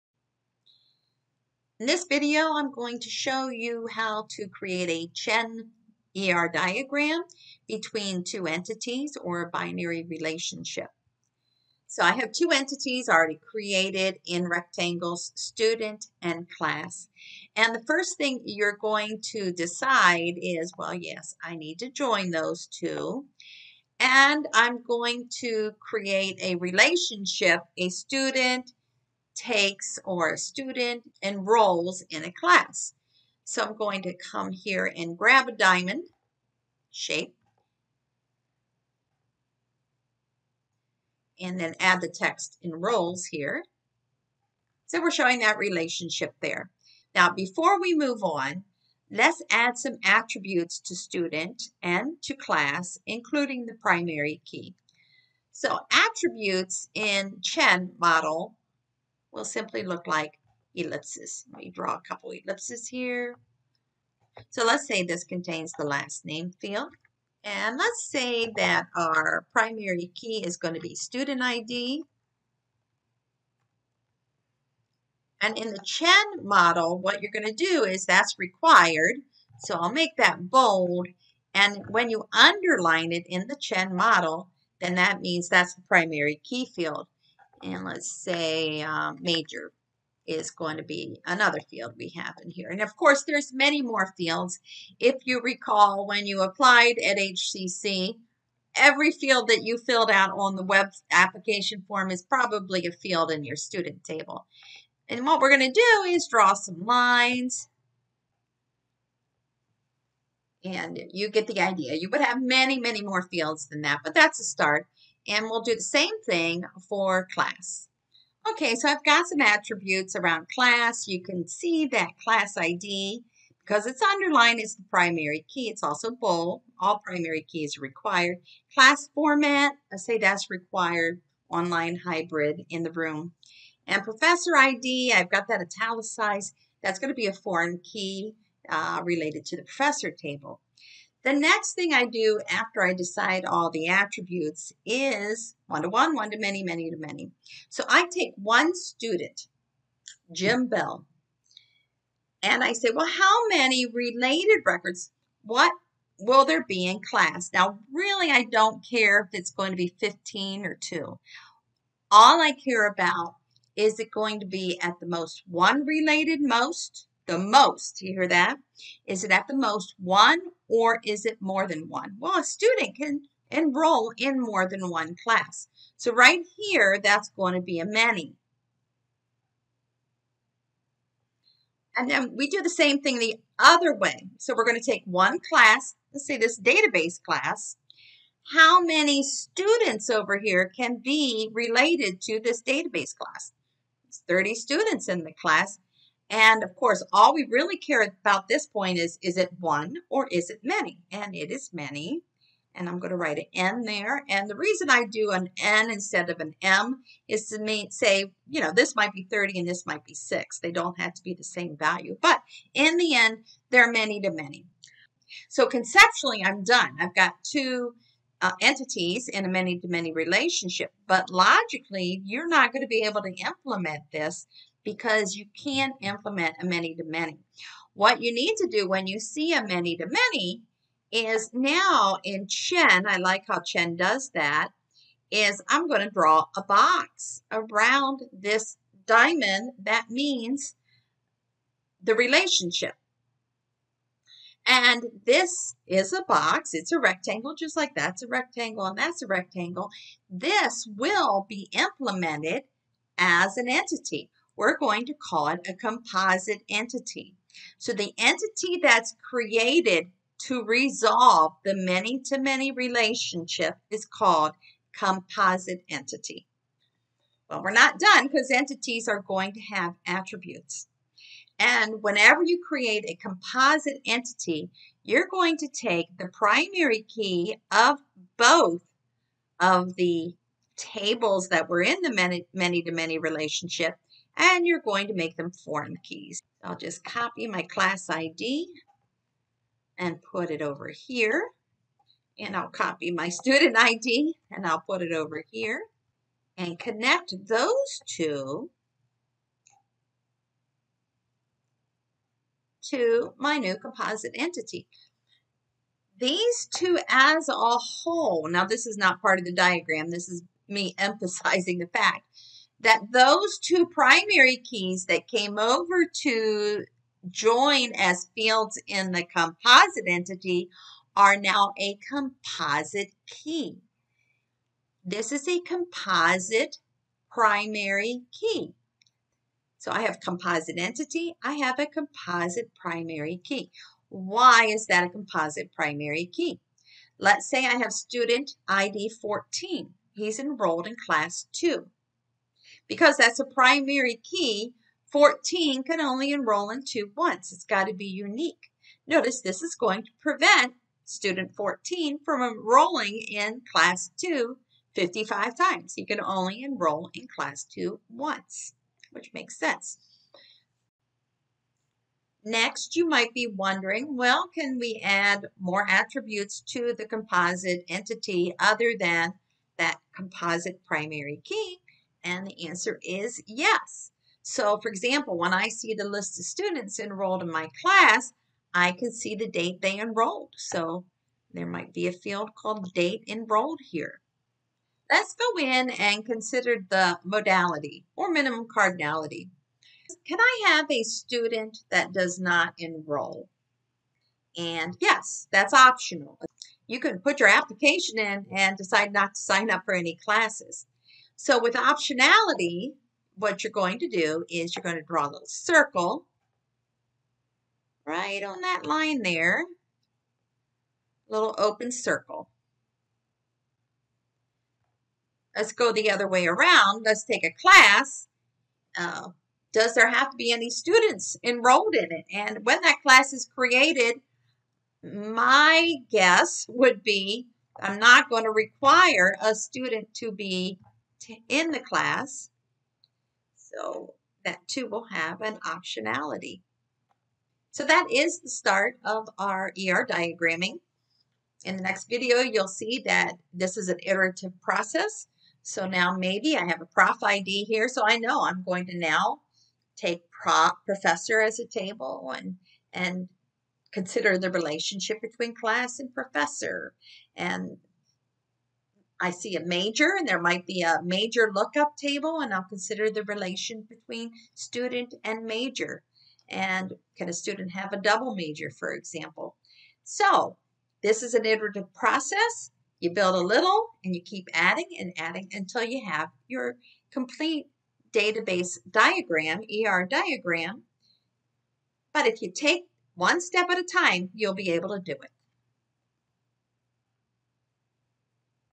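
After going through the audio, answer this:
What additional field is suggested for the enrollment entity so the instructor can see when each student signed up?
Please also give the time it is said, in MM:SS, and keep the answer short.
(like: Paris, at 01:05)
Date Enrolled, at 06:22.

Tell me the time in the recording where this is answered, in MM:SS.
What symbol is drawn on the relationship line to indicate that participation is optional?
06:51.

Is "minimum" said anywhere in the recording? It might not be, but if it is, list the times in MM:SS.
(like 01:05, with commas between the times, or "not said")
06:28.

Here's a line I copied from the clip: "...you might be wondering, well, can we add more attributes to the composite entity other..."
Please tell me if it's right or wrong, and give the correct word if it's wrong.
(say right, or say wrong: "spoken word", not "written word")
right.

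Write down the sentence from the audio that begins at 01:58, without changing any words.
Okay, so I've got some attributes around class.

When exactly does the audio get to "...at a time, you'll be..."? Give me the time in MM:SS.
08:03.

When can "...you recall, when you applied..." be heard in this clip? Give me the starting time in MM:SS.
01:35.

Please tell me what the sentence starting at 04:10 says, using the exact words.
This will be implemented as an entity we're going to call it a composite entity.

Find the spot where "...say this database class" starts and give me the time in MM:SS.
03:06.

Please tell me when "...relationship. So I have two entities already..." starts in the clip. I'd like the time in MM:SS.
00:10.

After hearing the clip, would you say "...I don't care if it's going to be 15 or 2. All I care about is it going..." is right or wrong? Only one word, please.
right.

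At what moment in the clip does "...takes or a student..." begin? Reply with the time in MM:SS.
00:29.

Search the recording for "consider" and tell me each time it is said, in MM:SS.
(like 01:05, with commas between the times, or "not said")
06:26, 07:33, 07:42.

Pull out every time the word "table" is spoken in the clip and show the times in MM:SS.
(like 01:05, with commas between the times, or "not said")
01:44, 02:20, 04:40, 07:31, 07:41.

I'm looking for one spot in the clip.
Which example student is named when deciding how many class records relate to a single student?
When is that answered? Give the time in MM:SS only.
02:30.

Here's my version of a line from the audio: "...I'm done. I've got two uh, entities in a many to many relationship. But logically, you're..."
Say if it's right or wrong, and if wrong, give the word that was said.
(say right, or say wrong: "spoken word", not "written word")
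right.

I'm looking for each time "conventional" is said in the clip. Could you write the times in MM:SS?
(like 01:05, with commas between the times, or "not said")
not said.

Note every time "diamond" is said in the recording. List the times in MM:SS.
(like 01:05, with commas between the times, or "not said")
00:35, 03:59.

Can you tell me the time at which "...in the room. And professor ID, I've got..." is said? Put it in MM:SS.
02:12.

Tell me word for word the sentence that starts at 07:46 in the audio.
And can a student have a double major, for example?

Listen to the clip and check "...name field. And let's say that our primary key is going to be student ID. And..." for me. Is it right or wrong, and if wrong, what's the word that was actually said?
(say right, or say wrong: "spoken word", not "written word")
right.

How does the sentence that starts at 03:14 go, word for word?
It's 30 students in the class.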